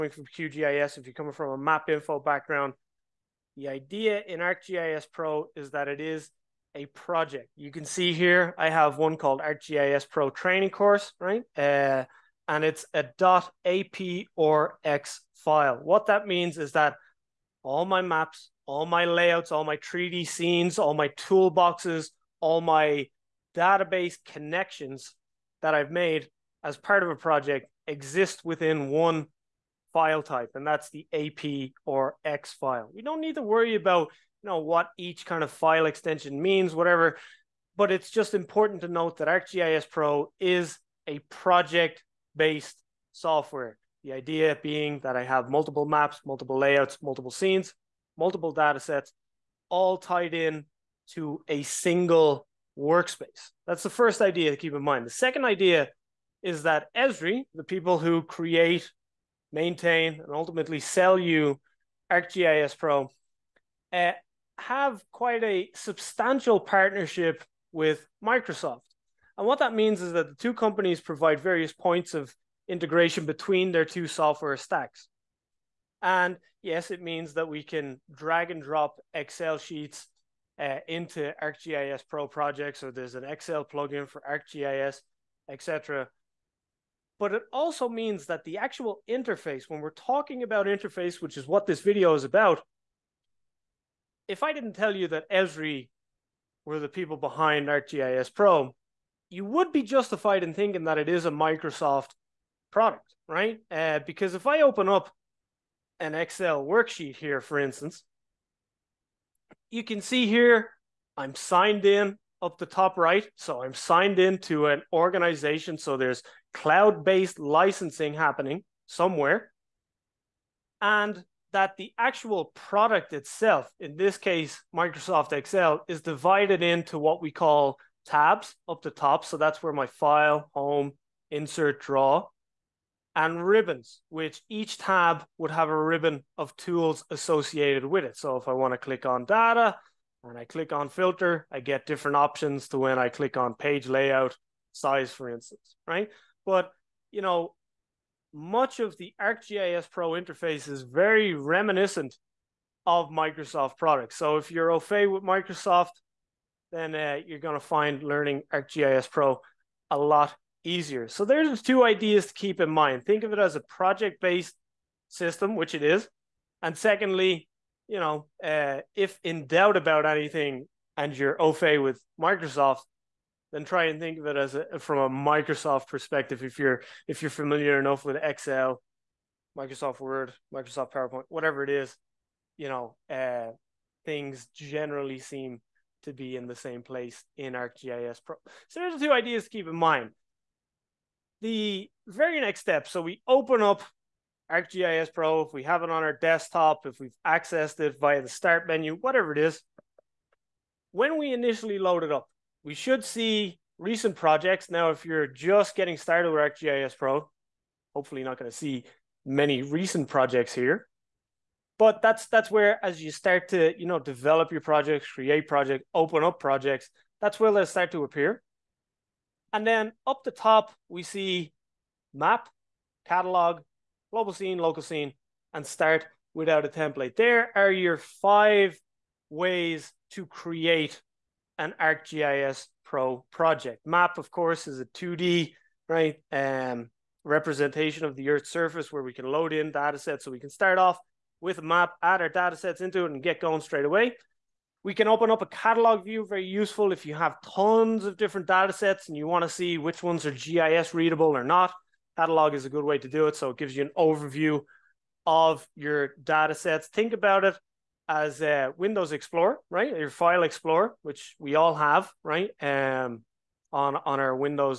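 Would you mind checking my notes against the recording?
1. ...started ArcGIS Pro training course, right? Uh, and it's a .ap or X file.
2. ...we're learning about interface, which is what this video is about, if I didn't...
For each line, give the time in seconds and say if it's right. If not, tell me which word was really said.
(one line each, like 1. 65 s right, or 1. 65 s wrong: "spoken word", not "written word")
1. 9 s wrong: "called", not "started"
2. 89 s wrong: "talking", not "learning".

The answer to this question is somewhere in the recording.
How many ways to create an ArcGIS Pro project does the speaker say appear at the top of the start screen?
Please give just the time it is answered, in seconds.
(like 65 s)
227 s.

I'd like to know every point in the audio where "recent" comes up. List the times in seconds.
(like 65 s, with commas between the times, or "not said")
203 s, 209 s.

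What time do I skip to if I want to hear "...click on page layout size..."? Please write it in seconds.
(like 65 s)
143 s.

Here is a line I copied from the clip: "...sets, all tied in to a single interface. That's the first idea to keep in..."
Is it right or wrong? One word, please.
wrong.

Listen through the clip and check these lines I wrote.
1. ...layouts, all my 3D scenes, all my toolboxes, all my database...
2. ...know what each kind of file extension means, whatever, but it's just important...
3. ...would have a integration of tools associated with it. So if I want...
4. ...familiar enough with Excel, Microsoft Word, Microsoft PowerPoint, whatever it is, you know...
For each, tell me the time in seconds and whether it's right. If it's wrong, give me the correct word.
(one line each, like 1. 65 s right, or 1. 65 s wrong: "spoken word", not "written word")
1. 19 s right
2. 34 s right
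3. 135 s wrong: "ribbon", not "integration"
4. 177 s right.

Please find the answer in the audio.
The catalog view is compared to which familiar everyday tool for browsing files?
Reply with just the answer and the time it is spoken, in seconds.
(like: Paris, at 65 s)
Windows Explorer, at 258 s.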